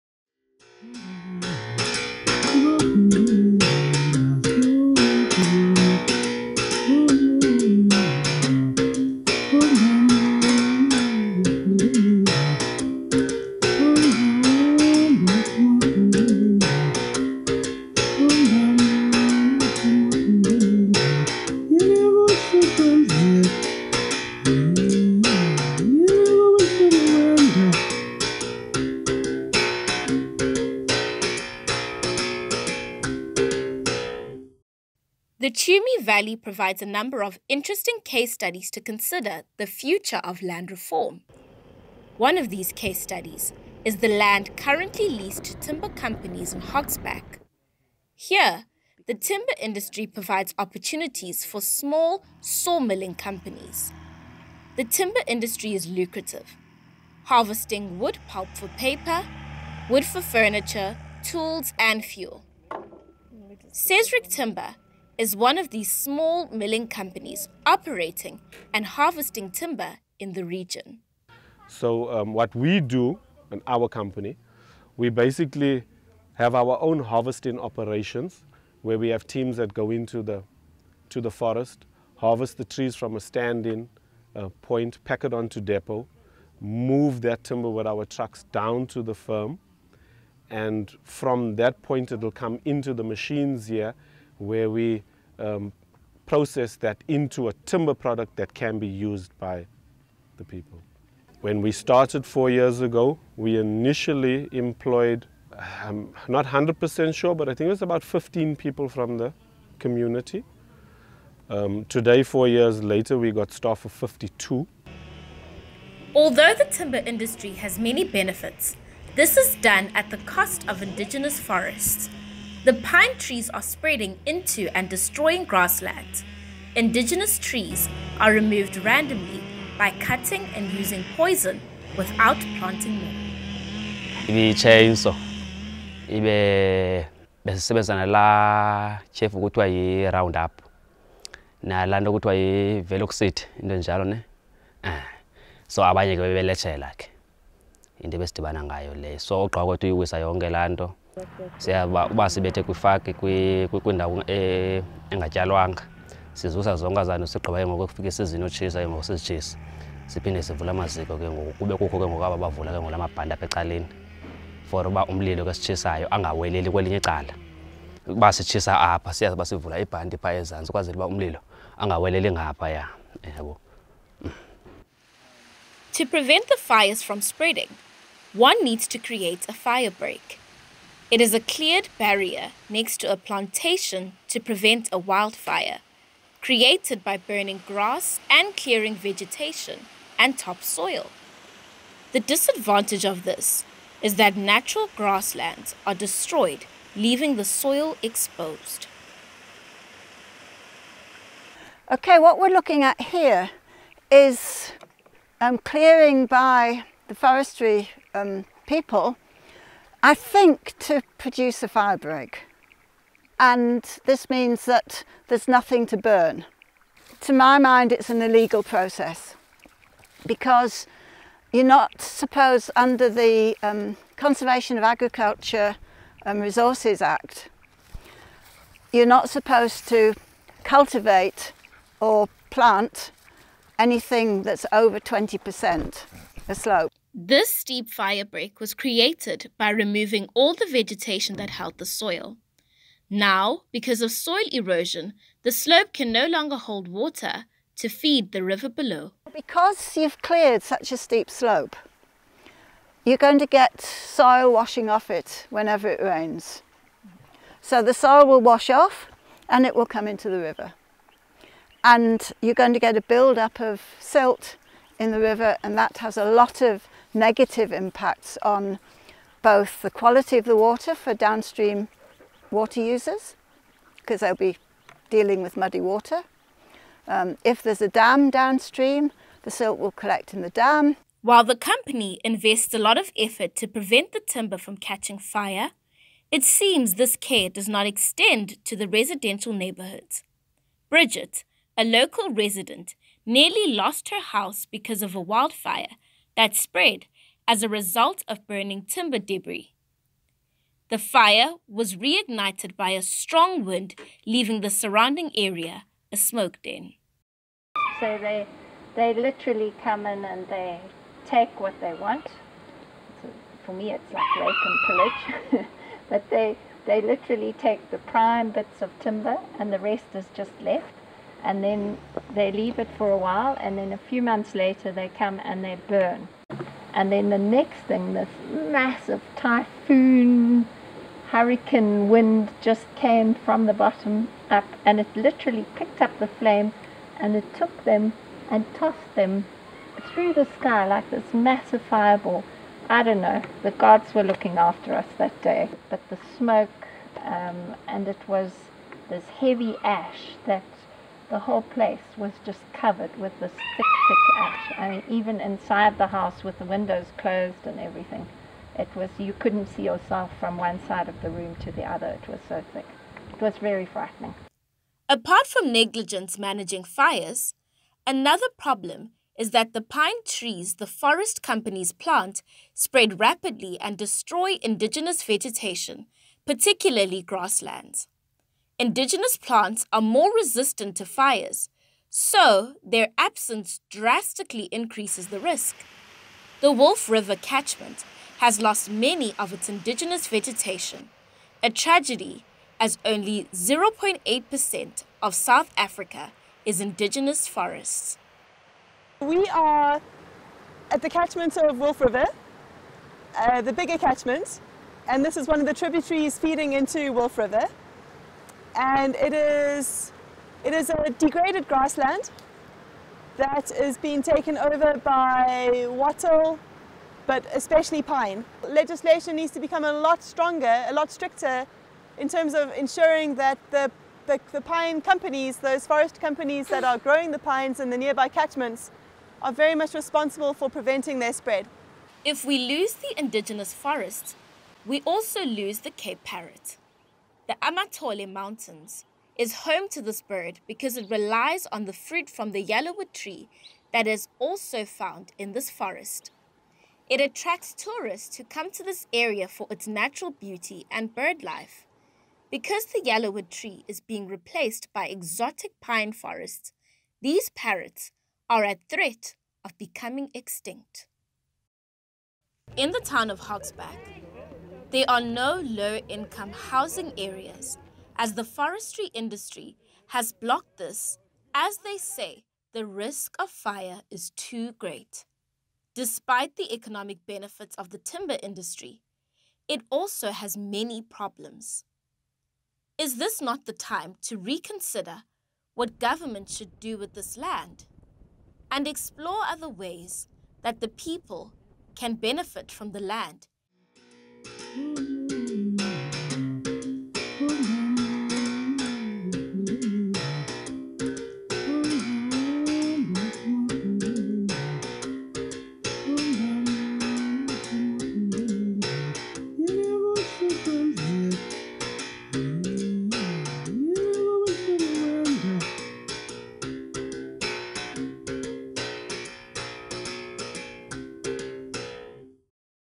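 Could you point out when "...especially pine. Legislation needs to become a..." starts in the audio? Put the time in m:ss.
6:57.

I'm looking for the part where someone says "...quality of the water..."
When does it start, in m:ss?
4:29.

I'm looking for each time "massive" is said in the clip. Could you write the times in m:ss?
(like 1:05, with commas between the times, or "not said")
5:28, 5:41.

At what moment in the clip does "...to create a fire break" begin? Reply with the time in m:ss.
2:58.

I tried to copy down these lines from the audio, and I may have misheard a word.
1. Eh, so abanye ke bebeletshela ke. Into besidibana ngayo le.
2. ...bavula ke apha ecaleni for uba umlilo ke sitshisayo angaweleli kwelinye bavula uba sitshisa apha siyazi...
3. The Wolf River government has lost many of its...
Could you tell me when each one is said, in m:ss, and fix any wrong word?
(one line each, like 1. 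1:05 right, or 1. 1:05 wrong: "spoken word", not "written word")
1. 2:24 right
2. 2:42 wrong: "icala", not "bavula"
3. 6:26 wrong: "catchment", not "government".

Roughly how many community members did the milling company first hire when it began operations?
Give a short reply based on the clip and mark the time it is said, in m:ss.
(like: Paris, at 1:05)
15, at 1:48.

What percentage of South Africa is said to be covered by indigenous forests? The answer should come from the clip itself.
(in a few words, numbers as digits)
0.8%.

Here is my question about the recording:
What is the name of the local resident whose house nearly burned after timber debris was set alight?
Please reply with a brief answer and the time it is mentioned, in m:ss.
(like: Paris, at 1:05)
Bridget, at 4:50.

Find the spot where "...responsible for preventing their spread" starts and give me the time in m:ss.
7:09.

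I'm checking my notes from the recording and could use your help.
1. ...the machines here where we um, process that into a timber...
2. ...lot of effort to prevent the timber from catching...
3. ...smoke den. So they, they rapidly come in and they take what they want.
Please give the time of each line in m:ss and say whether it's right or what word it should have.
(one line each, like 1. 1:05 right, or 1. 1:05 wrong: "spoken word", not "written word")
1. 1:32 right
2. 4:42 right
3. 5:06 wrong: "literally", not "rapidly".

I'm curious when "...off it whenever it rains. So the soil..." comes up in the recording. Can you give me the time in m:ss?
4:14.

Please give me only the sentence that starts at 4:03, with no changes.
Now, because of soil erosion, the slope can no longer hold water to feed the river below.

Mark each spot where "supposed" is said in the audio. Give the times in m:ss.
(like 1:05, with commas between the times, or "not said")
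3:42, 3:49.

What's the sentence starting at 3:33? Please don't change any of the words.
And this means that there's nothing to burn.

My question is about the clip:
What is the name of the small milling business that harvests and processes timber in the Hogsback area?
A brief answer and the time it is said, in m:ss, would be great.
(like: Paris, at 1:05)
Sazerac Timber, at 1:03.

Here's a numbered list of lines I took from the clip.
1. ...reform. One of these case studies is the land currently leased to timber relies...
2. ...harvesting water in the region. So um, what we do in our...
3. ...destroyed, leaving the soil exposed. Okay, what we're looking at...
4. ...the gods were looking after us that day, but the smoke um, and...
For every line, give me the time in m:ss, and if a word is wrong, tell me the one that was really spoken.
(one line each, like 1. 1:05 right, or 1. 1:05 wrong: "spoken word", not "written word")
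1. 0:40 wrong: "companies", not "relies"
2. 1:08 wrong: "timber", not "water"
3. 3:15 right
4. 5:43 right.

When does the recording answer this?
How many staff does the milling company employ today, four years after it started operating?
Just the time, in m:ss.
1:53.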